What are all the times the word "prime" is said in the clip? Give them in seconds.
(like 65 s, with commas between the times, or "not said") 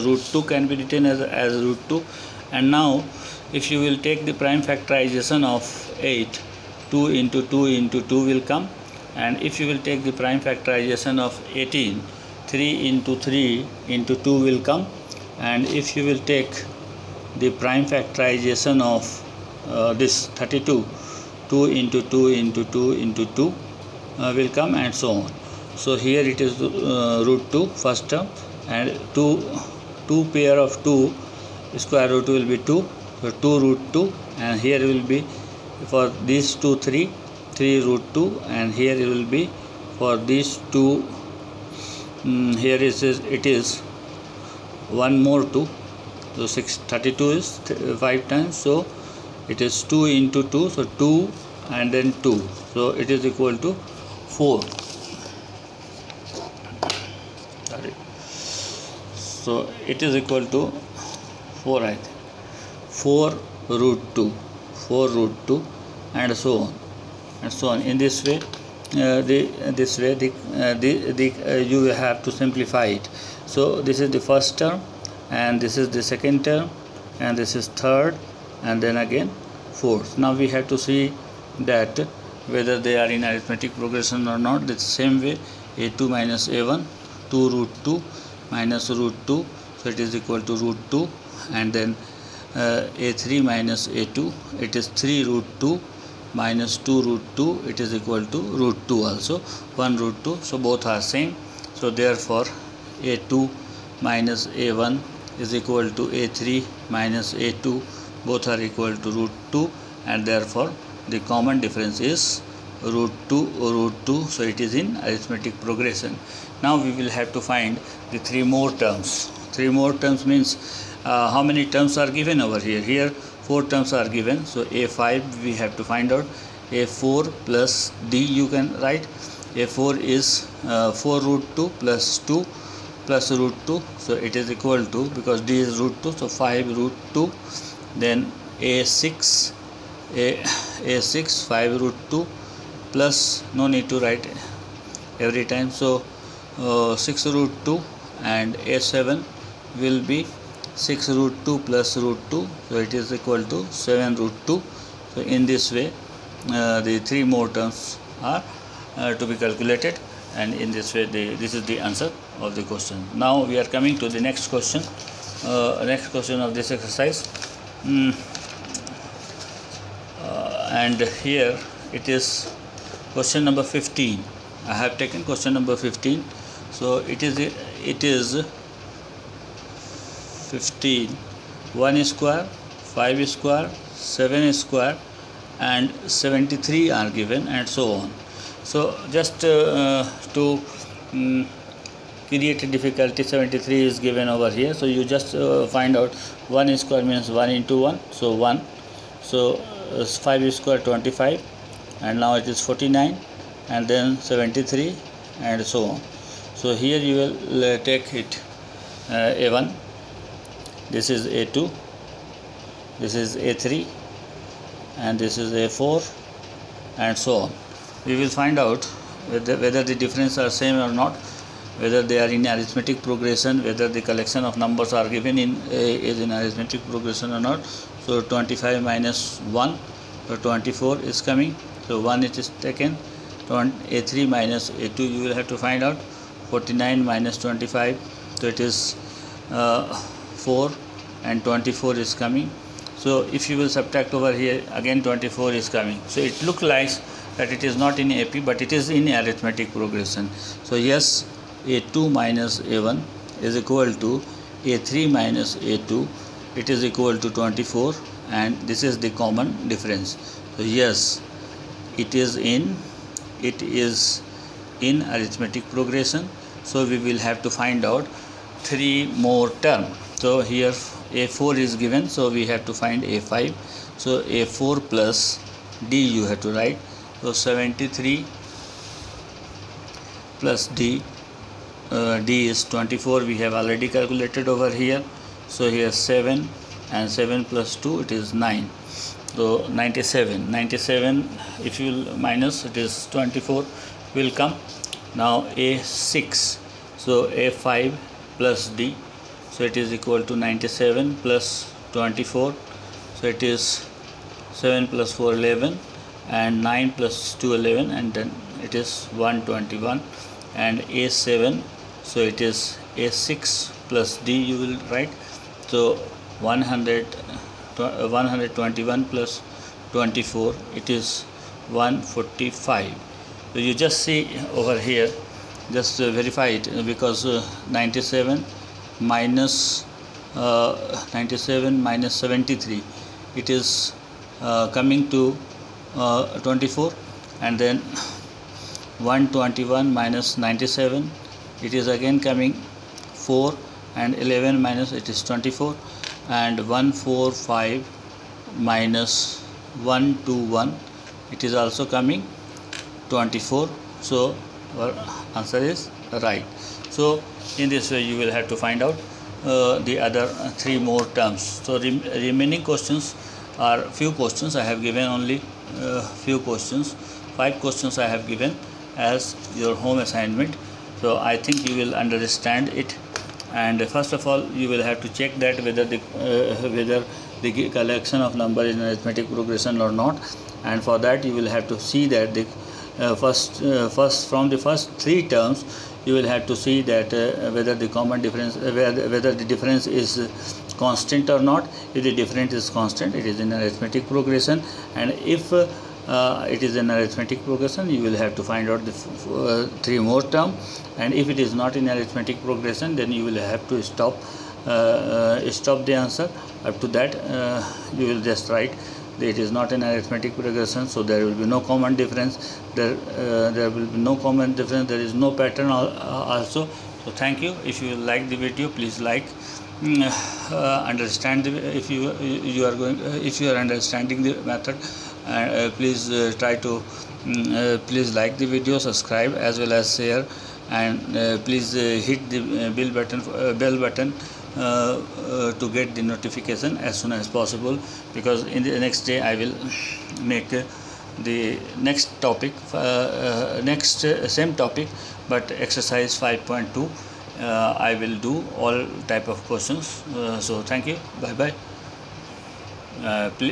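4 s, 10 s, 17 s.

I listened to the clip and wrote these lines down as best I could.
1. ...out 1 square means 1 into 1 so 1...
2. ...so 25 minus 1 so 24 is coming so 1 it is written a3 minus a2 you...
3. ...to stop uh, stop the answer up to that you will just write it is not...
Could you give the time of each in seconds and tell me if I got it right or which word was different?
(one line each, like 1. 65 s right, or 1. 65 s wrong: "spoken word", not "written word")
1. 196 s right
2. 228 s wrong: "taken", not "written"
3. 403 s right.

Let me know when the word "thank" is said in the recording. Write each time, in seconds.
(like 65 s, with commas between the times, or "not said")
417 s, 450 s.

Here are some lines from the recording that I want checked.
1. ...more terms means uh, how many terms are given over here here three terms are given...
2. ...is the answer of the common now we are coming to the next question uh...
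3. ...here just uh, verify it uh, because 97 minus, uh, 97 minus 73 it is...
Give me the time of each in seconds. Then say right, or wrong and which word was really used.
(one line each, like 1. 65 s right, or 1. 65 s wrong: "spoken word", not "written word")
1. 119 s wrong: "four", not "three"
2. 161 s wrong: "question", not "common"
3. 324 s right.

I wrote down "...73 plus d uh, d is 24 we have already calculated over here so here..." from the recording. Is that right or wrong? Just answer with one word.
right.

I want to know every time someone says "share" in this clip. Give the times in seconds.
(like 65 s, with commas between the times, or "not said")
429 s.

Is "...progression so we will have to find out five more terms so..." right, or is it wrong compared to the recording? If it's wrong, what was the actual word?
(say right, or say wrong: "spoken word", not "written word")
wrong: "three", not "five".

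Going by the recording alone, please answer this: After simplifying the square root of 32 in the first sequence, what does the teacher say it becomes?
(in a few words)
4 root 2.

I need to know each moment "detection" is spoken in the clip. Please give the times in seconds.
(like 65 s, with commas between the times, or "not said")
not said.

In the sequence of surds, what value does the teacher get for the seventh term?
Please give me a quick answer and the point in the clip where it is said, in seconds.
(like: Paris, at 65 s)
7 root 2, at 153 s.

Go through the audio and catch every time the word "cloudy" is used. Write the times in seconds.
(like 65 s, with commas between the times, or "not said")
not said.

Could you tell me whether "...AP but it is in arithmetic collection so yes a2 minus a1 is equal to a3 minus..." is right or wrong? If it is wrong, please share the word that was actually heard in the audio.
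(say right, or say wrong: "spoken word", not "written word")
wrong: "progression", not "collection".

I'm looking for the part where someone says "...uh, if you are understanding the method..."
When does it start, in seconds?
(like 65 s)
423 s.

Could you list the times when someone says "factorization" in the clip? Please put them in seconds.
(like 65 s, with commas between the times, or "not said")
4 s, 10 s, 17 s.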